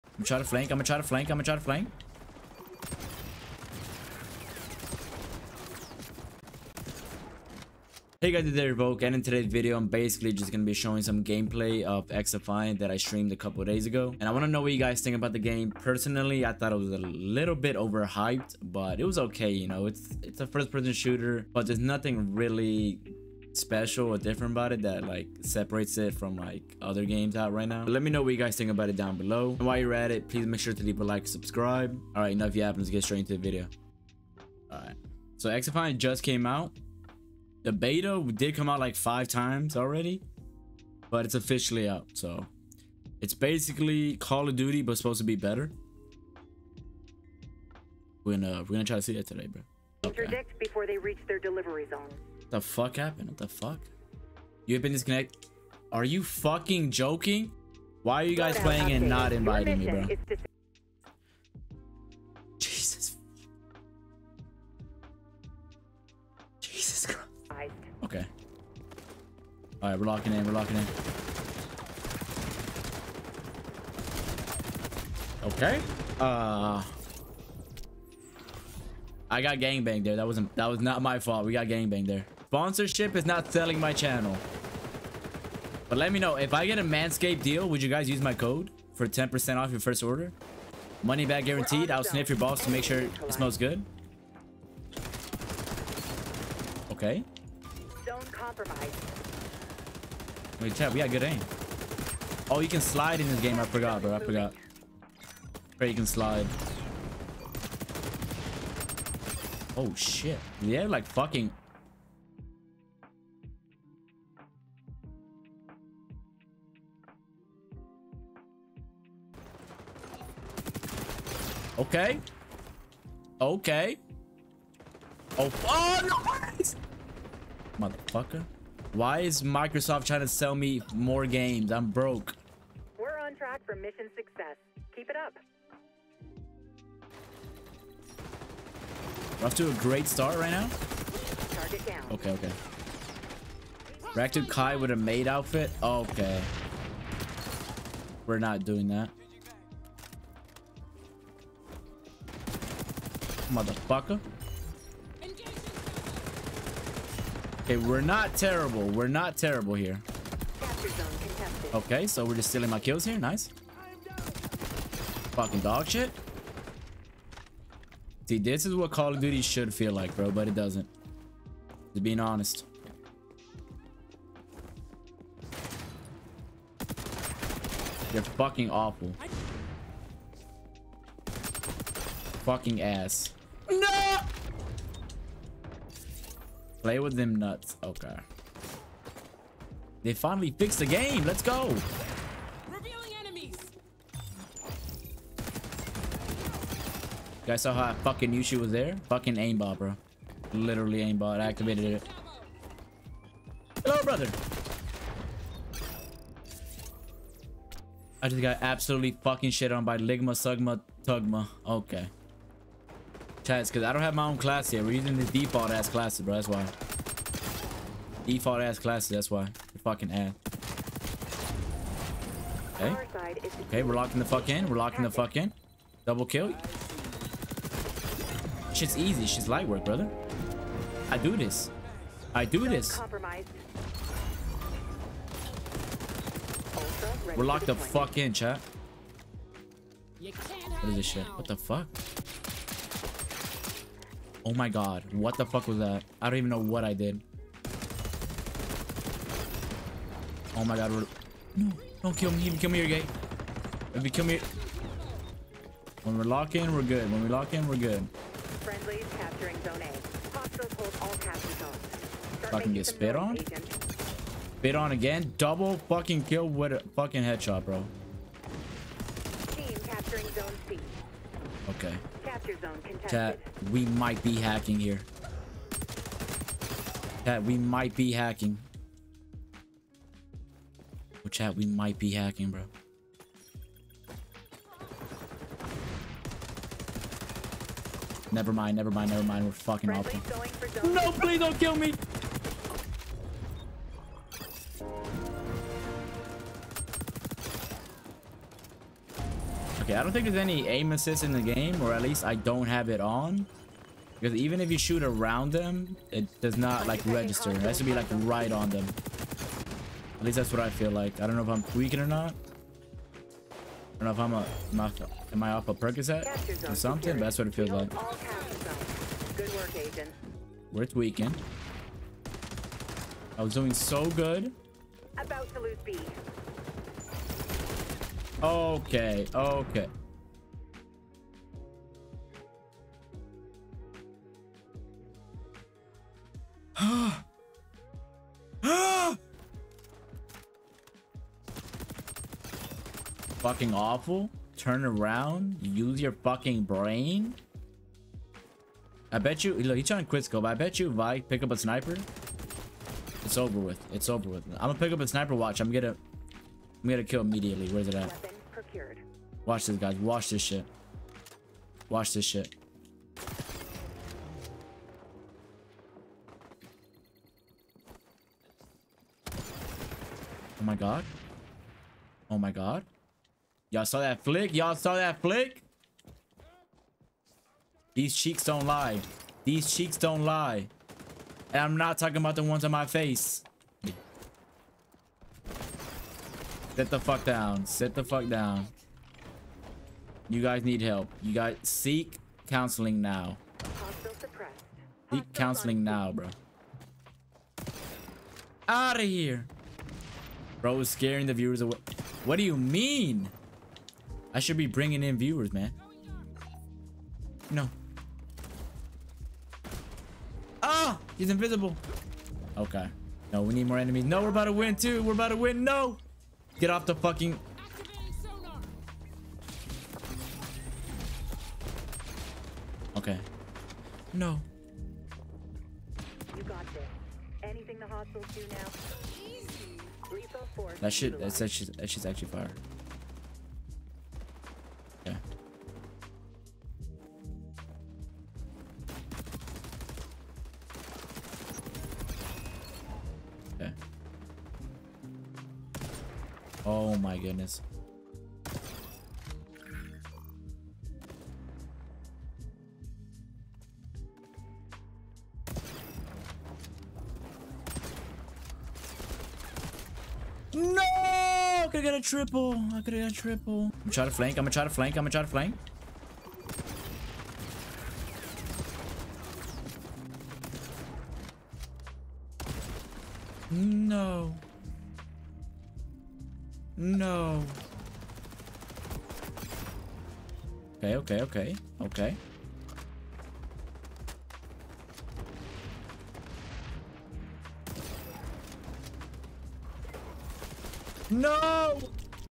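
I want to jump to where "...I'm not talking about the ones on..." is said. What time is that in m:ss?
6:21.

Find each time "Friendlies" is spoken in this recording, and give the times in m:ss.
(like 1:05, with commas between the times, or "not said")
4:18.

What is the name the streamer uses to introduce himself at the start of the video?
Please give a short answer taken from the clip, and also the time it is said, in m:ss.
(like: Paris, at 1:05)
Revoke, at 0:08.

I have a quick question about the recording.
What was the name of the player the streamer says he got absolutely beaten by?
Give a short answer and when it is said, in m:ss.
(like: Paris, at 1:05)
Ligma Sugma Tugma, at 3:29.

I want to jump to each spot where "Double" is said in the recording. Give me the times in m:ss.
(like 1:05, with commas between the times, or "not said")
3:46, 4:25.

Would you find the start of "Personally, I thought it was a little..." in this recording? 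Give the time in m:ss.
0:15.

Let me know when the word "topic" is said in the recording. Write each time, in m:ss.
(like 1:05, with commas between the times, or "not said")
not said.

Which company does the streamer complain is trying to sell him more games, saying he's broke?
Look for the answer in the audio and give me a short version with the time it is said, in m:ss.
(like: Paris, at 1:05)
Microsoft, at 2:09.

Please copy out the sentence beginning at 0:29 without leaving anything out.
And while you're at it, please make sure to leave a like, subscribe.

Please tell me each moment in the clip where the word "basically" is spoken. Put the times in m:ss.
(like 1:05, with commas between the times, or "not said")
0:09, 0:43.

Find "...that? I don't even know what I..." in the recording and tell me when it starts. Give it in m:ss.
4:05.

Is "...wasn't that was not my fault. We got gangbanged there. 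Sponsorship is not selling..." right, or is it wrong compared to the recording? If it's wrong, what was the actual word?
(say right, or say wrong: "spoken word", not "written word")
right.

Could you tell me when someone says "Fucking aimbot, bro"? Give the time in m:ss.
3:19.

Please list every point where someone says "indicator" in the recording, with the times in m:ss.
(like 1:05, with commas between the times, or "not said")
not said.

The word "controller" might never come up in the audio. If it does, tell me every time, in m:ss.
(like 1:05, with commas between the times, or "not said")
not said.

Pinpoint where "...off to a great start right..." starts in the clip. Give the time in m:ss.
2:19.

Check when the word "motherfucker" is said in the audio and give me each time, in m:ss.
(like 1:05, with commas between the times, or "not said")
2:07, 2:33.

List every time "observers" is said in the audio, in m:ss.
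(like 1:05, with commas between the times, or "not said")
not said.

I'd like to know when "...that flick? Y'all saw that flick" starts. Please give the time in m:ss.
6:13.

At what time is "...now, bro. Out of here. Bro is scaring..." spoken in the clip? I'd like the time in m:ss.
6:35.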